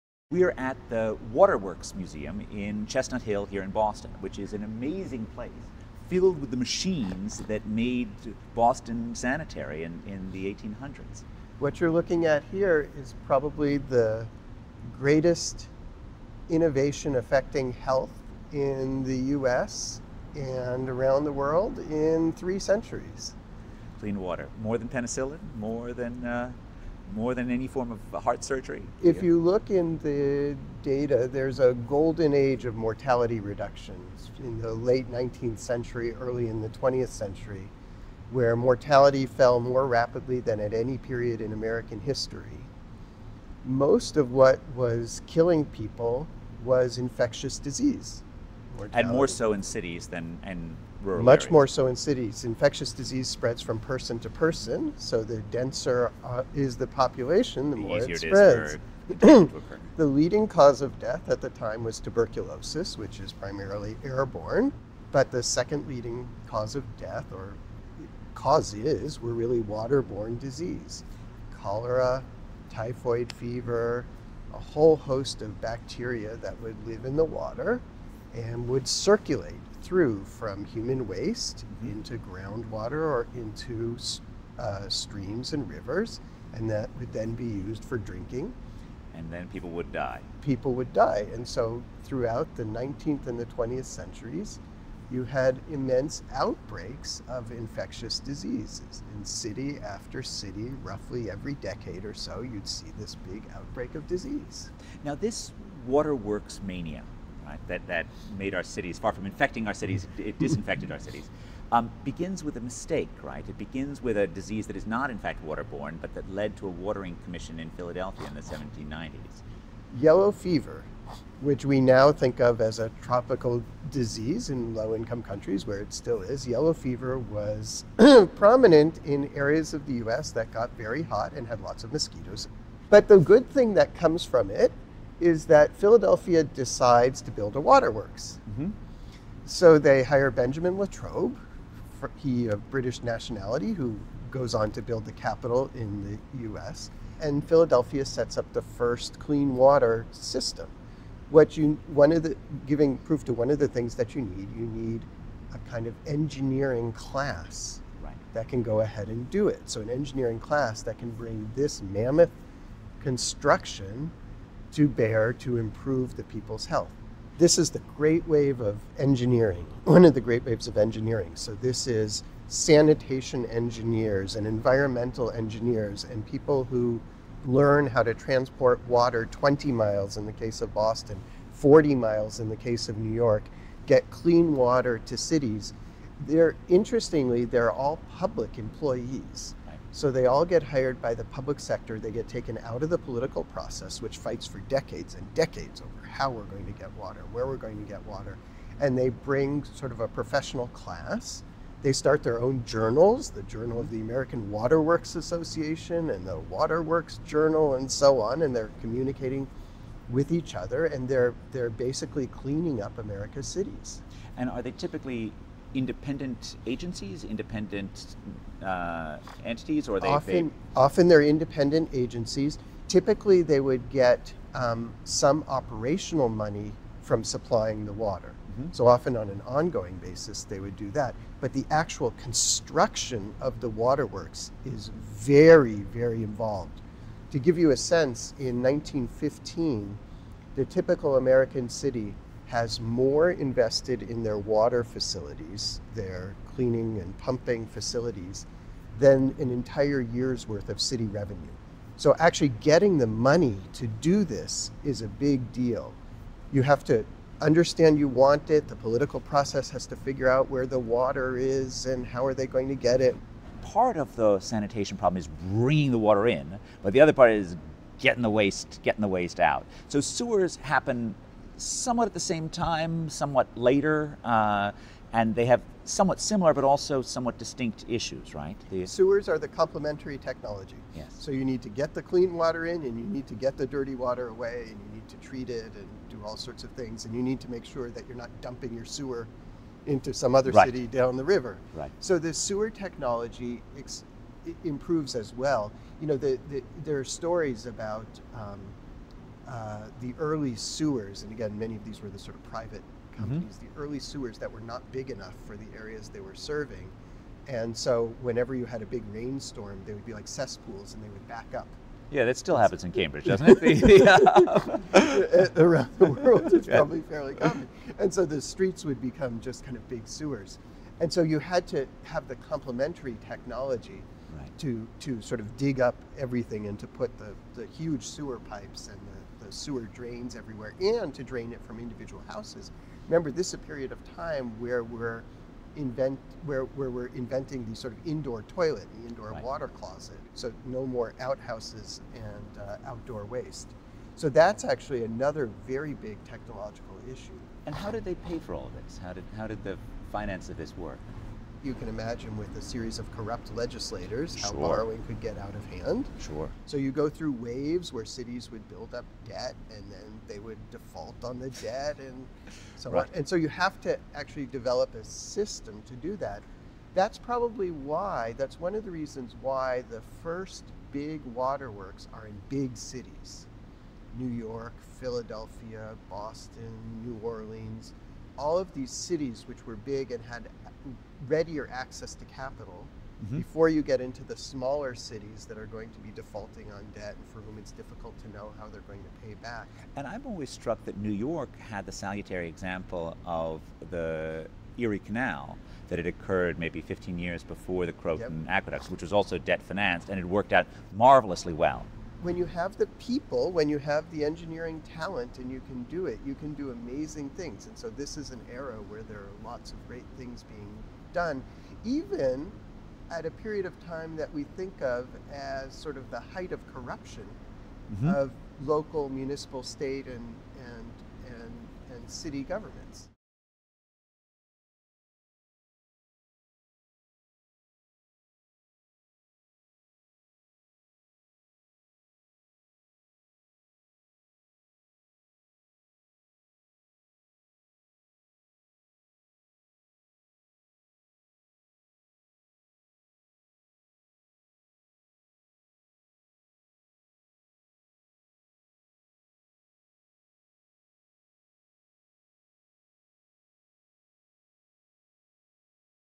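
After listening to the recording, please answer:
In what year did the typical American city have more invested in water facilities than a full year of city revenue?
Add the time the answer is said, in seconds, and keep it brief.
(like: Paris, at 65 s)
1915, at 238 s.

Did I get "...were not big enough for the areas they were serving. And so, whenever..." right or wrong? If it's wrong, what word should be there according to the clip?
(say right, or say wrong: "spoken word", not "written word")
right.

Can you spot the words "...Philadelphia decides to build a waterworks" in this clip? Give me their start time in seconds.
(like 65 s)
135 s.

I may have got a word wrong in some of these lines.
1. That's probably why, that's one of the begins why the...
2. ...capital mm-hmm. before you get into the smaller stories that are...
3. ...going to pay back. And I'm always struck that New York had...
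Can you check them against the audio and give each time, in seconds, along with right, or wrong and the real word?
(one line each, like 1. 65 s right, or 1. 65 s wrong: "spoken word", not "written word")
1. 366 s wrong: "reasons", not "begins"
2. 382 s wrong: "cities", not "stories"
3. 388 s right.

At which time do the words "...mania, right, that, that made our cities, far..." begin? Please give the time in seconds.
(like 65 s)
106 s.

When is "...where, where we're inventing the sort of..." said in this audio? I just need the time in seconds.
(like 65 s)
336 s.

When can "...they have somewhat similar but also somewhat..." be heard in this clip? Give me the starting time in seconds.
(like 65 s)
275 s.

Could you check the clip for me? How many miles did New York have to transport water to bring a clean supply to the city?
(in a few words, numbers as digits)
40.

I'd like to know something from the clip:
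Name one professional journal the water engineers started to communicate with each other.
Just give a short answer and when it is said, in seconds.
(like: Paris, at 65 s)
Journal of the American Waterworks Association, at 203 s.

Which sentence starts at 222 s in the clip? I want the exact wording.
Typically, they would get um, some operational money from supplying the water.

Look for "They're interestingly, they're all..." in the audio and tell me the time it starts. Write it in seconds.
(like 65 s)
186 s.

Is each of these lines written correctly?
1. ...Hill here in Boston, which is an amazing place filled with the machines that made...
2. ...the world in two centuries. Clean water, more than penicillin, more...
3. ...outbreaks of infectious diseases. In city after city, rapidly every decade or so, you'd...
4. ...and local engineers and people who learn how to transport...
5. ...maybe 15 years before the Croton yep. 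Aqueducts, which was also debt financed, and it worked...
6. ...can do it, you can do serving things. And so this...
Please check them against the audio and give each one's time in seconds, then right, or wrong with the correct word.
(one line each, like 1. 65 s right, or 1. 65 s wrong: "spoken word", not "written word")
1. 3 s right
2. 21 s wrong: "three", not "two"
3. 96 s wrong: "roughly", not "rapidly"
4. 174 s wrong: "environmental", not "local"
5. 396 s right
6. 405 s wrong: "amazing", not "serving".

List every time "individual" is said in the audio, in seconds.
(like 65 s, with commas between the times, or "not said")
331 s.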